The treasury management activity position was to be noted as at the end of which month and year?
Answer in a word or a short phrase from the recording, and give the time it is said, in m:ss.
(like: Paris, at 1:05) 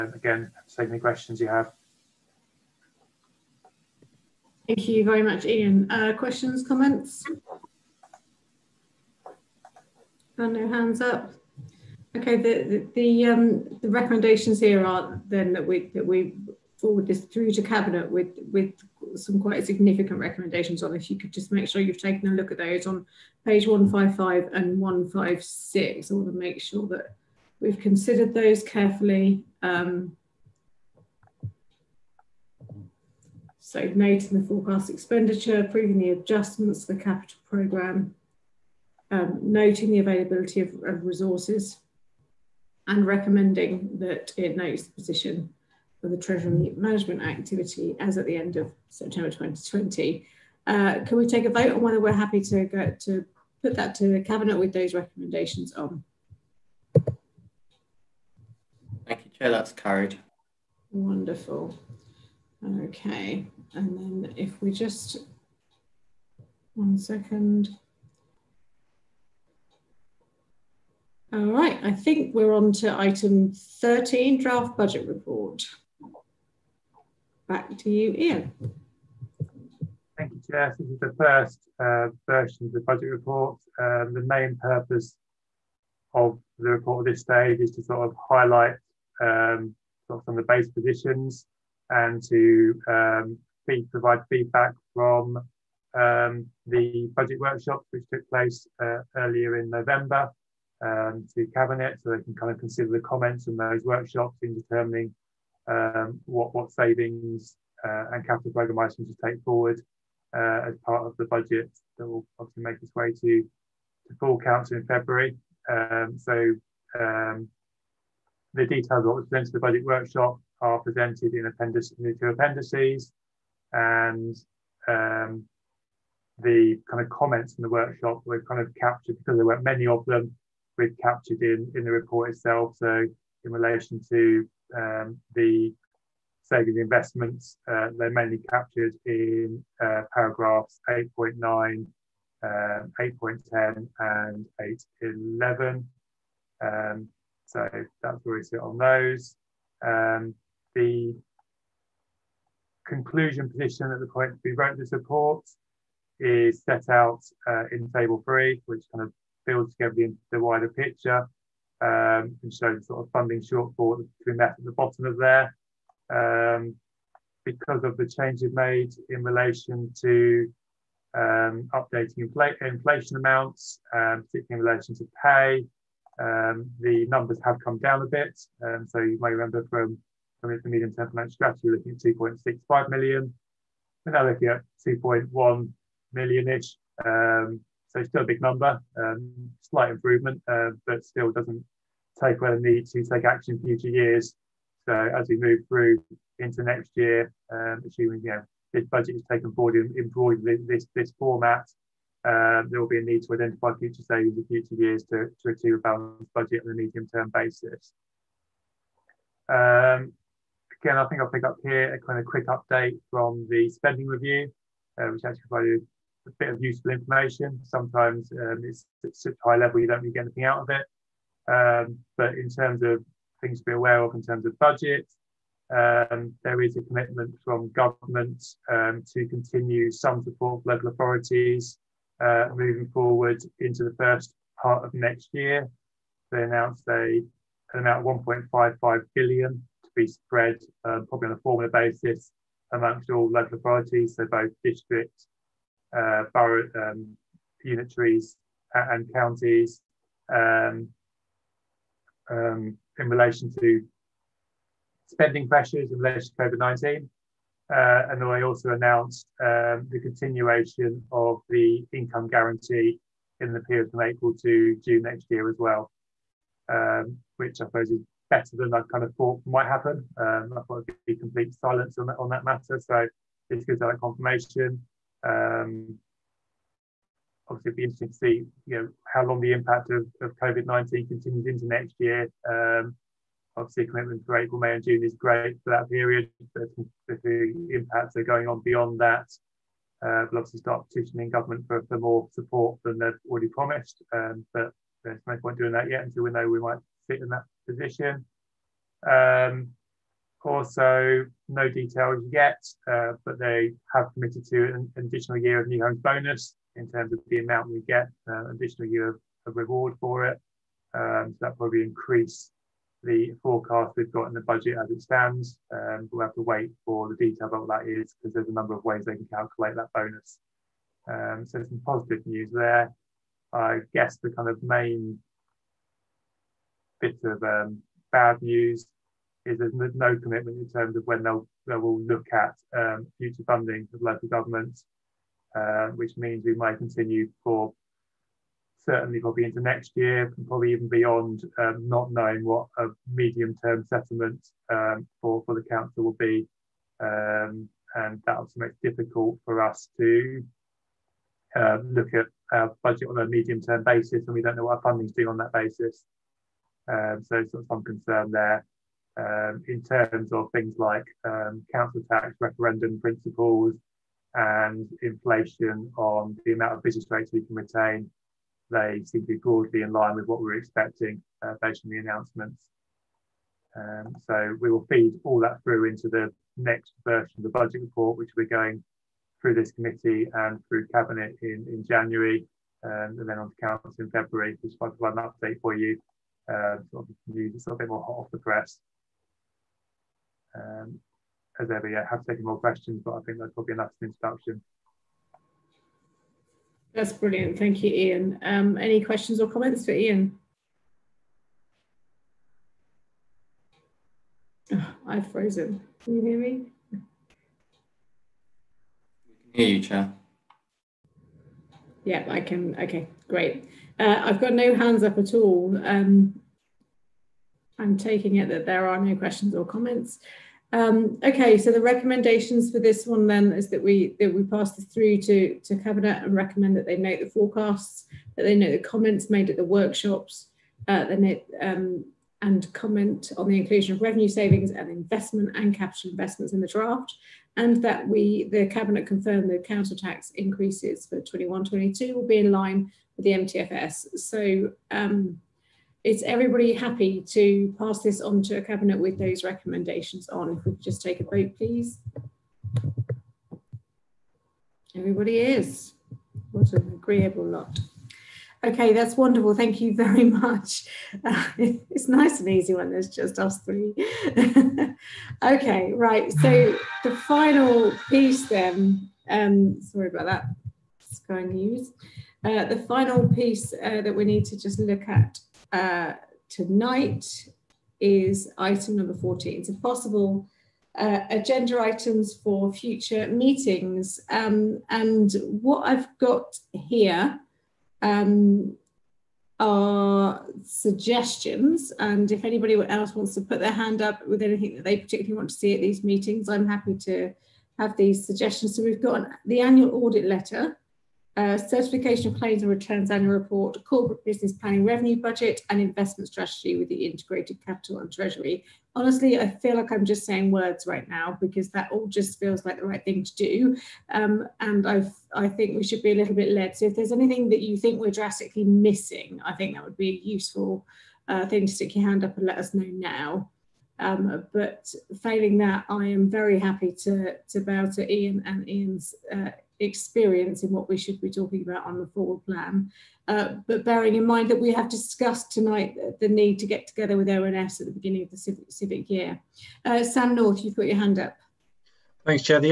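September 2020, at 0:48.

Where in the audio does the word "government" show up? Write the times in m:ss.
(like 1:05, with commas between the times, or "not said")
3:47, 4:51, 5:34.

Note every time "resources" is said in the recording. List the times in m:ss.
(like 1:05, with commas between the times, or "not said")
0:41.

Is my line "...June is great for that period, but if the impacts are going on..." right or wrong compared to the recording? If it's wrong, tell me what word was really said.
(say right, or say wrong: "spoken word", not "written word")
right.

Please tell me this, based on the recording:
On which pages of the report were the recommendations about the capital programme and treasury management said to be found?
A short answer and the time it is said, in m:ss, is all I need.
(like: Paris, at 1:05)
155 and 156, at 0:23.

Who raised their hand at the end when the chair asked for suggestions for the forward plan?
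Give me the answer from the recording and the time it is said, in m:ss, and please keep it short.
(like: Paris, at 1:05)
Sam North, at 9:00.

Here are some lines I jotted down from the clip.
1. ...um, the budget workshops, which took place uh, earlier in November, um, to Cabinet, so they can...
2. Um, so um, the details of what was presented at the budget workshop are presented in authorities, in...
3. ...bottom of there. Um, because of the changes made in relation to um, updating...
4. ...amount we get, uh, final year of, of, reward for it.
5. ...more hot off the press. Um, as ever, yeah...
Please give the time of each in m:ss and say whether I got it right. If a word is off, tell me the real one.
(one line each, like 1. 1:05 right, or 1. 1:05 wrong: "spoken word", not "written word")
1. 1:35 right
2. 1:55 wrong: "appendices", not "authorities"
3. 2:44 right
4. 5:07 wrong: "additional", not "final"
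5. 6:27 right.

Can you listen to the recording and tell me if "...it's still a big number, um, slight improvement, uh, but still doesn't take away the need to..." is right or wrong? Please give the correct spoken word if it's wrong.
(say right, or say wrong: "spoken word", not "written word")
right.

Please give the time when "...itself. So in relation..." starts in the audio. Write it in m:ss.
2:12.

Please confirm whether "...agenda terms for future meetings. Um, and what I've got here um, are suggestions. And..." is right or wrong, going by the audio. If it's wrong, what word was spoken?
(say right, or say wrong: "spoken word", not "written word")
wrong: "items", not "terms".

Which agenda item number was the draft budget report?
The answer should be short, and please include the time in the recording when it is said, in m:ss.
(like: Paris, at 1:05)
13, at 1:12.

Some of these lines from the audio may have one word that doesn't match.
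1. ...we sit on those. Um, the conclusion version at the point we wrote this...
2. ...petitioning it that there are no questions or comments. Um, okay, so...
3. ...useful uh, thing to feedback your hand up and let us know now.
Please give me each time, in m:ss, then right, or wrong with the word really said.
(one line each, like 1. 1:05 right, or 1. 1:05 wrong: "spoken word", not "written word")
1. 2:28 wrong: "position", not "version"
2. 6:57 wrong: "taking", not "petitioning"
3. 8:40 wrong: "stick", not "feedback".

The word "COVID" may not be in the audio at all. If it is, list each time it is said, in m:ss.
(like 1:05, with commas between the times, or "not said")
4:16, 4:40.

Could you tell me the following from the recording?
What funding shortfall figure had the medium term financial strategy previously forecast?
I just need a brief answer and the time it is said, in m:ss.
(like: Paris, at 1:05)
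2.65 million, at 3:01.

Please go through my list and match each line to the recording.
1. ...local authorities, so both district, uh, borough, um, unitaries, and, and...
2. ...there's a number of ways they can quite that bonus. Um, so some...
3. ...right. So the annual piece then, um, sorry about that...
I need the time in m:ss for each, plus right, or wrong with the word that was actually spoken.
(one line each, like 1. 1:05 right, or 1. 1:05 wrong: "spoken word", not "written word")
1. 4:03 right
2. 5:18 wrong: "calculate", not "quite"
3. 7:45 wrong: "final", not "annual".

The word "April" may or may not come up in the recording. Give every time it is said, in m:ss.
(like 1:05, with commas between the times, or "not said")
4:24, 4:44.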